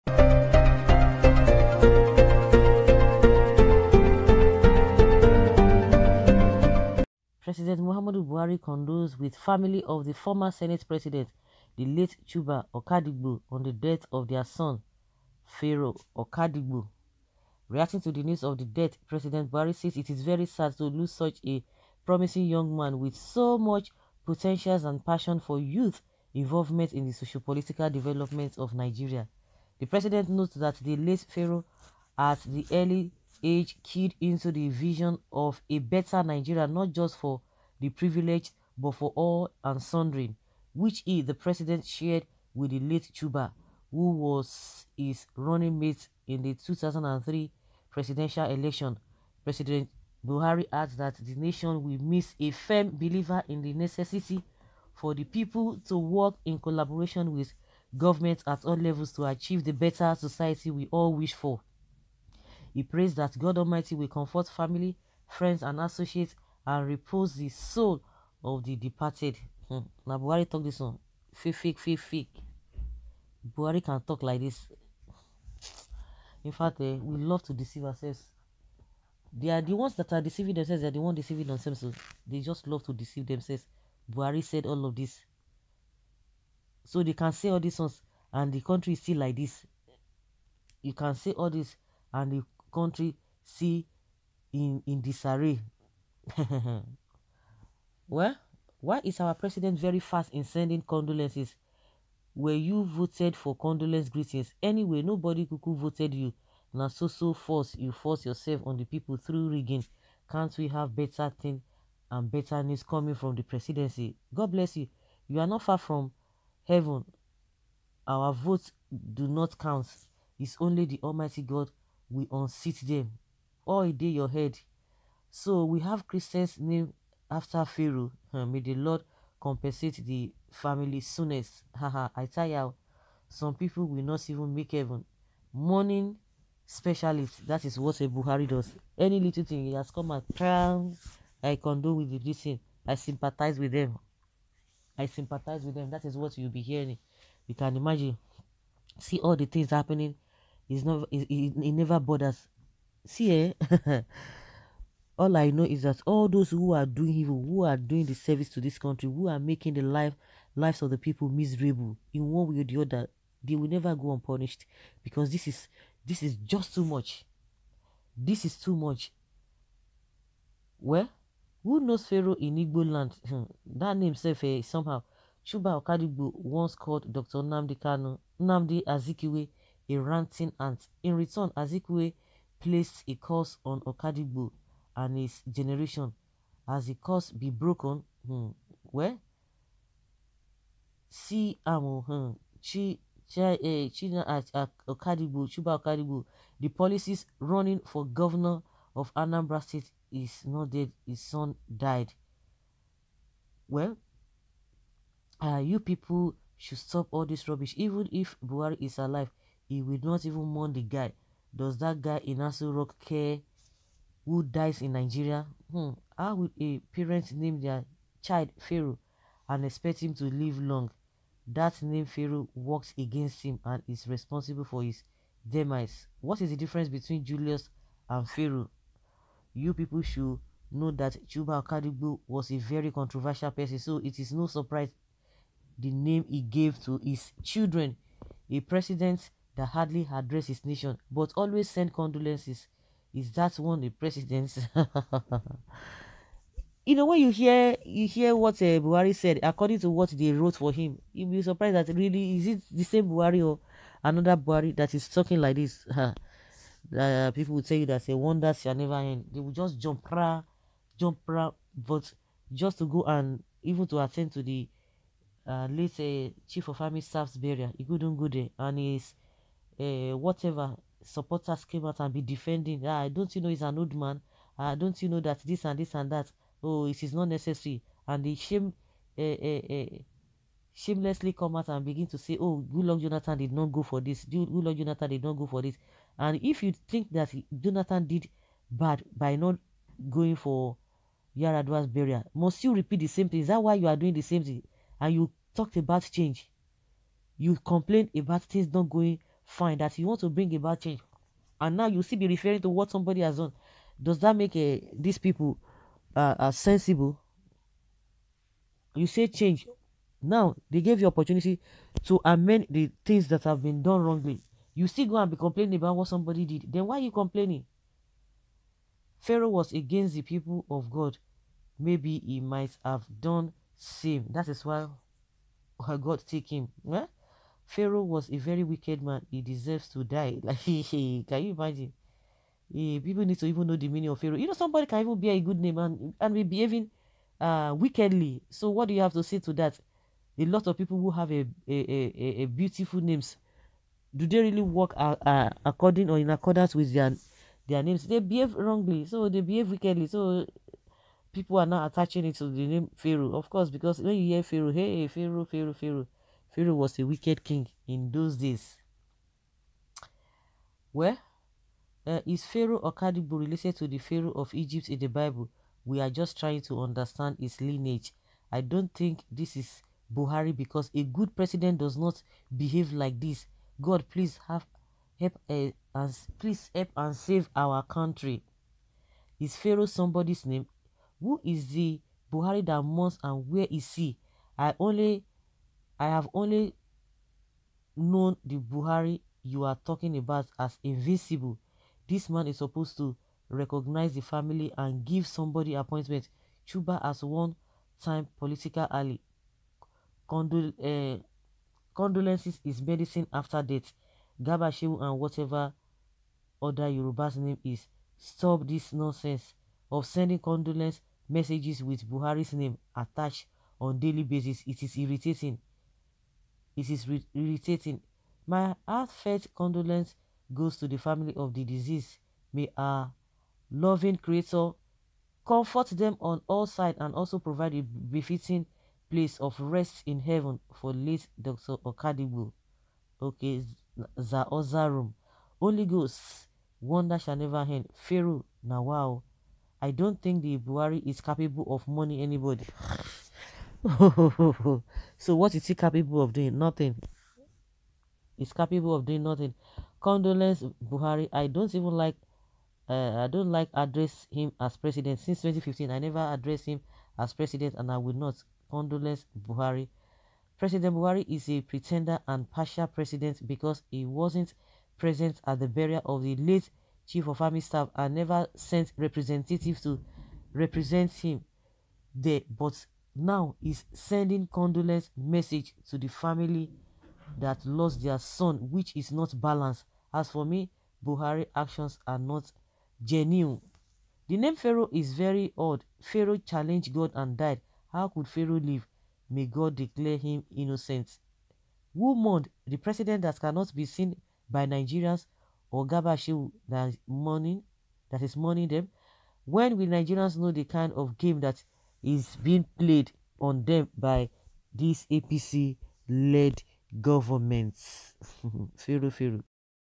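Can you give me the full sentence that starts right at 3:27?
Even if Buhari is alive, he will not even mourn the guy.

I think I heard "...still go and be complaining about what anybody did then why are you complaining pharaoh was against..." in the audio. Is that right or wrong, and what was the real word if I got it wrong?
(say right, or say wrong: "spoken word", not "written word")
wrong: "somebody", not "anybody".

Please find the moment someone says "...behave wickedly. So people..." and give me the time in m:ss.
5:49.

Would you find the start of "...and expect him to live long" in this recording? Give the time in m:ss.
3:39.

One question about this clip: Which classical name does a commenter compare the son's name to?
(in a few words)
Julius.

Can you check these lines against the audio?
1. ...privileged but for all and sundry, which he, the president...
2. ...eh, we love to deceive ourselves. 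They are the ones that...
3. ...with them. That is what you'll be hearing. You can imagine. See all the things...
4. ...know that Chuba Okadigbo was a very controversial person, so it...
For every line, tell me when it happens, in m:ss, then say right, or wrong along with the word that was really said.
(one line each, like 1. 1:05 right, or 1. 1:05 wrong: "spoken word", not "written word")
1. 0:37 right
2. 1:16 right
3. 2:25 right
4. 3:50 right.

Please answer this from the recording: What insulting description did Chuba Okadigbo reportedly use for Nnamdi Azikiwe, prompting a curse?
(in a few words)
a ranting ant.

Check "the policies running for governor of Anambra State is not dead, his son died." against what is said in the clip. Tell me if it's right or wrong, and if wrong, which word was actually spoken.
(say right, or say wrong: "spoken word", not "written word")
right.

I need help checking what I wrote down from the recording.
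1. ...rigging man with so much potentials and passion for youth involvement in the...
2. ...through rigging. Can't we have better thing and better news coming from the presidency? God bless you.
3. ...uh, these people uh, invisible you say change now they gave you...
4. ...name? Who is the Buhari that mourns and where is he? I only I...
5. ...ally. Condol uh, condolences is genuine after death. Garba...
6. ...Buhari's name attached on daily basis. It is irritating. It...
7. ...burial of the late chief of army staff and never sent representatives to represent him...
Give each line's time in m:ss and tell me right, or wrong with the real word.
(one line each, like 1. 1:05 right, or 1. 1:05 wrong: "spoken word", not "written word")
1. 0:22 wrong: "young", not "rigging"
2. 1:49 right
3. 5:04 wrong: "sensible", not "invisible"
4. 6:20 right
5. 6:38 wrong: "medicine", not "genuine"
6. 6:52 right
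7. 7:45 right.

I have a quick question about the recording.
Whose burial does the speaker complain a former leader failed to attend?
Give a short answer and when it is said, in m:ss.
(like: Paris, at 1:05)
Yar'Adua, at 4:51.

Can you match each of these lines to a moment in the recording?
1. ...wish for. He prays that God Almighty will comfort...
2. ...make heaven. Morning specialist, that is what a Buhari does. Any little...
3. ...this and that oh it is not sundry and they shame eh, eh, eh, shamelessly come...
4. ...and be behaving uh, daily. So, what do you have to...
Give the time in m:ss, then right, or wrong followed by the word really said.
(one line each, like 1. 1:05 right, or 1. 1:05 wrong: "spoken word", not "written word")
1. 1:01 right
2. 2:14 right
3. 4:35 wrong: "necessary", not "sundry"
4. 5:36 wrong: "wickedly", not "daily".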